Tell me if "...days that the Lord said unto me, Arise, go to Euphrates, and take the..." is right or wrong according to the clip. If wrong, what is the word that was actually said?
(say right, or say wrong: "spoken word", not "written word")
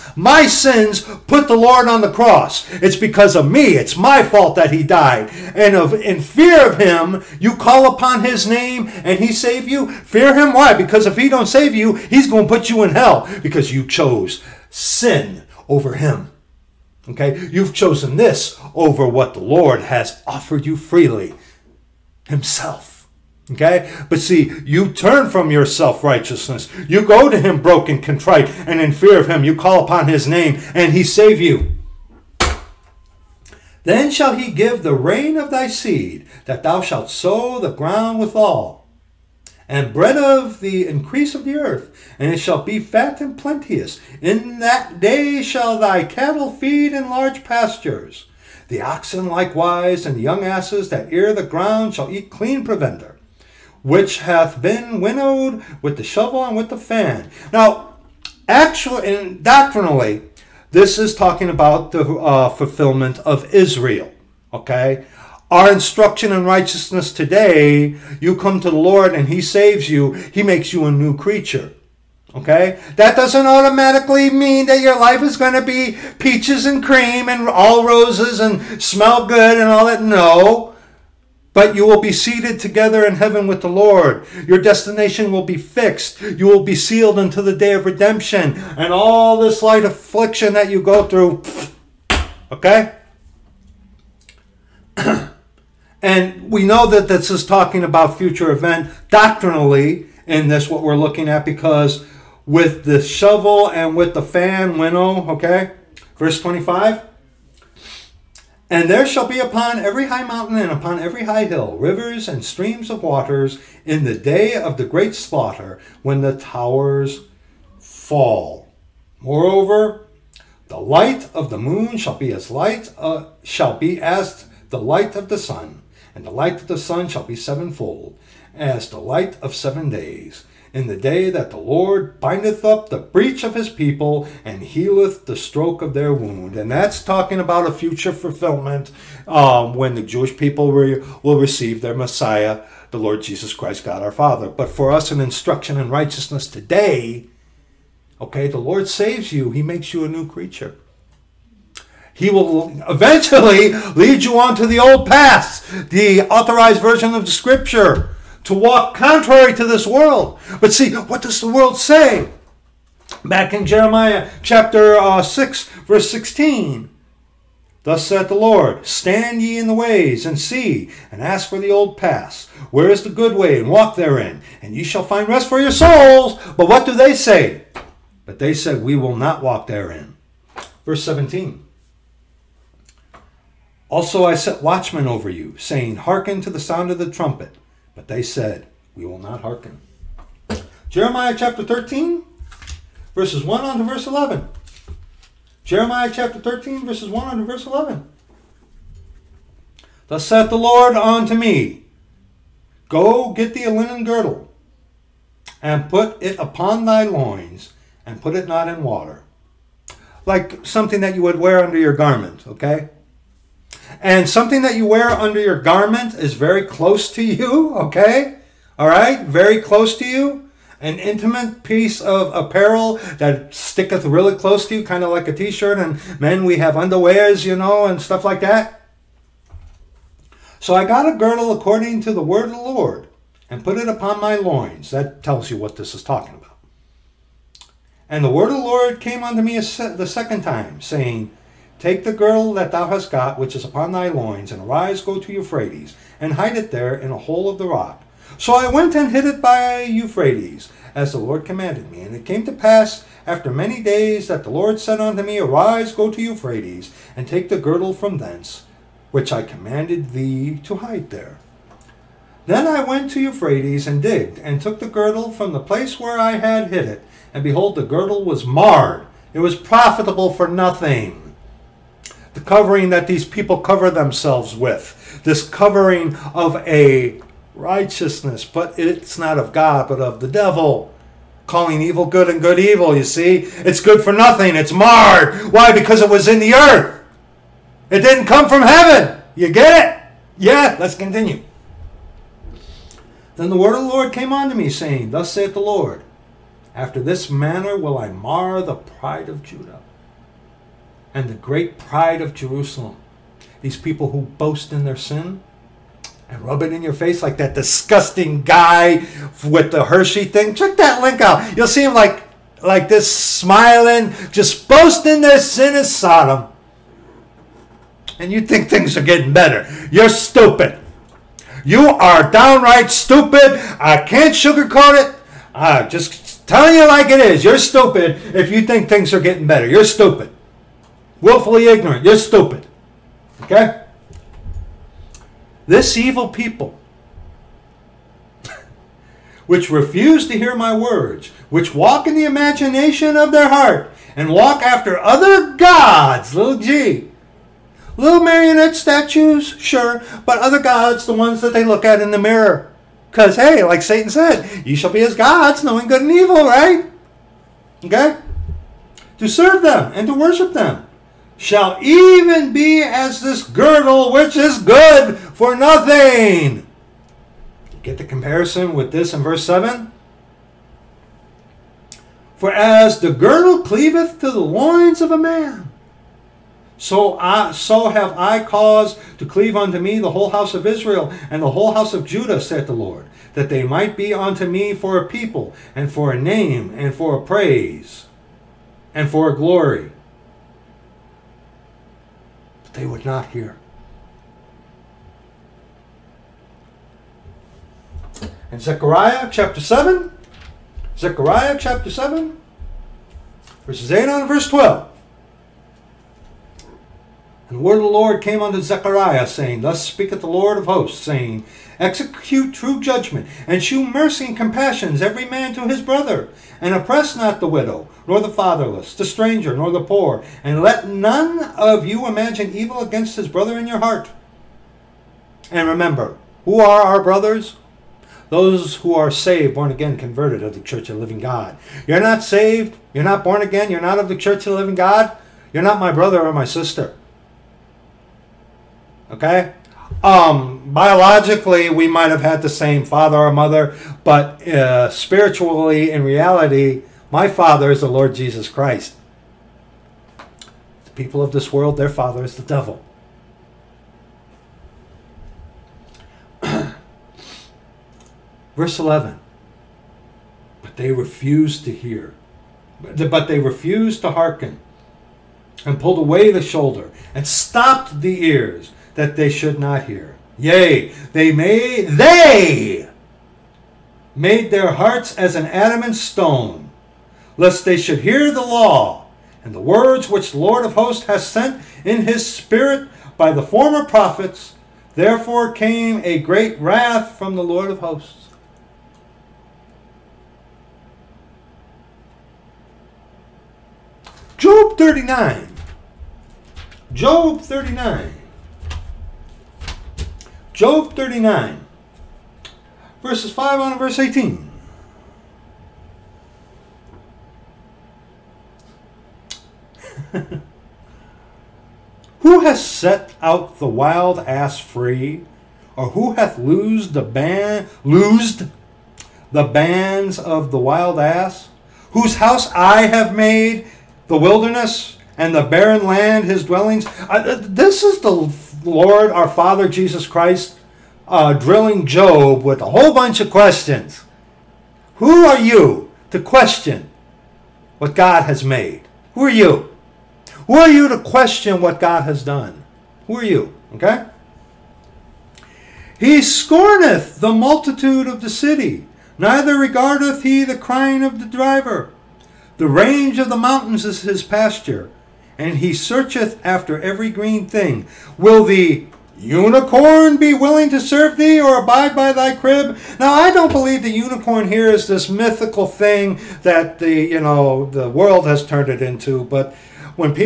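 right.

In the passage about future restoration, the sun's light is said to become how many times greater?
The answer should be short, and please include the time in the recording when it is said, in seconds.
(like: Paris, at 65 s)
7, at 127 s.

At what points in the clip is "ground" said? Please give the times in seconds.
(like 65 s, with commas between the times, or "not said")
37 s, 51 s.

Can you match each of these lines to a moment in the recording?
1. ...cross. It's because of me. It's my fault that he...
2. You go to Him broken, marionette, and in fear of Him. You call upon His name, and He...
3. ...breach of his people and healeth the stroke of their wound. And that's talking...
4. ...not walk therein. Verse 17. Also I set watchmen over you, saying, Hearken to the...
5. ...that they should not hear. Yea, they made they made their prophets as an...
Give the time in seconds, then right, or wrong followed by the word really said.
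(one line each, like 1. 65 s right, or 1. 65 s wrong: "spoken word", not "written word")
1. 2 s right
2. 26 s wrong: "contrite", not "marionette"
3. 132 s right
4. 179 s right
5. 468 s wrong: "hearts", not "prophets".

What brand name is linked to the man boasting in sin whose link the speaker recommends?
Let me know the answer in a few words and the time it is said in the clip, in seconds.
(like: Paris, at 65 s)
Hershey, at 309 s.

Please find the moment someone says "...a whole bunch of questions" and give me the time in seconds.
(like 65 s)
532 s.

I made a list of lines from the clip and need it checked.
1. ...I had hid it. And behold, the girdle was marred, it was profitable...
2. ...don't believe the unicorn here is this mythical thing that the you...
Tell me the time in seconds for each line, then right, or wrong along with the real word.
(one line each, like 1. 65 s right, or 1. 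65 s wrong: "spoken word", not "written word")
1. 266 s right
2. 563 s right.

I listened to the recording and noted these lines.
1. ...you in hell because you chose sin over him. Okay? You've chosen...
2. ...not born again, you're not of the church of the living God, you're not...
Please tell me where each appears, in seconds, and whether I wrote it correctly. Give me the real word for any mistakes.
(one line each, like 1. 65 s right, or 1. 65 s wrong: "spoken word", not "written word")
1. 12 s right
2. 433 s right.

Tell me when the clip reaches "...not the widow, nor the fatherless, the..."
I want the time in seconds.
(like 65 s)
417 s.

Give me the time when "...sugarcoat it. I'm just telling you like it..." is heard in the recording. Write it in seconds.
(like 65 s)
324 s.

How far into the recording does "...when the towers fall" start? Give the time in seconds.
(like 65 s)
116 s.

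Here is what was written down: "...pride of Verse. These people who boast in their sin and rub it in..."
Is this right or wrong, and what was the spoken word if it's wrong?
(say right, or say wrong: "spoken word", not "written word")
wrong: "Jerusalem", not "Verse".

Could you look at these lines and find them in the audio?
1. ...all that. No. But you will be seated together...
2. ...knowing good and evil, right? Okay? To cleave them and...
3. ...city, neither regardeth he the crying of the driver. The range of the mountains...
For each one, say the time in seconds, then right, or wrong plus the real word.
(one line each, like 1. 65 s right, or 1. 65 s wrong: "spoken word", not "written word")
1. 79 s right
2. 355 s wrong: "serve", not "cleave"
3. 548 s right.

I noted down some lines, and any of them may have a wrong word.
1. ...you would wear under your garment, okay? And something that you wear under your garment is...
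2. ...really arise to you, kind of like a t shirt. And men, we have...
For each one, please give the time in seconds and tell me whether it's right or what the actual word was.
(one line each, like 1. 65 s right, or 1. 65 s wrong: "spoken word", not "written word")
1. 211 s right
2. 224 s wrong: "close", not "arise".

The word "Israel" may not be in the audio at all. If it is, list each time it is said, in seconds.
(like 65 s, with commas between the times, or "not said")
63 s, 380 s.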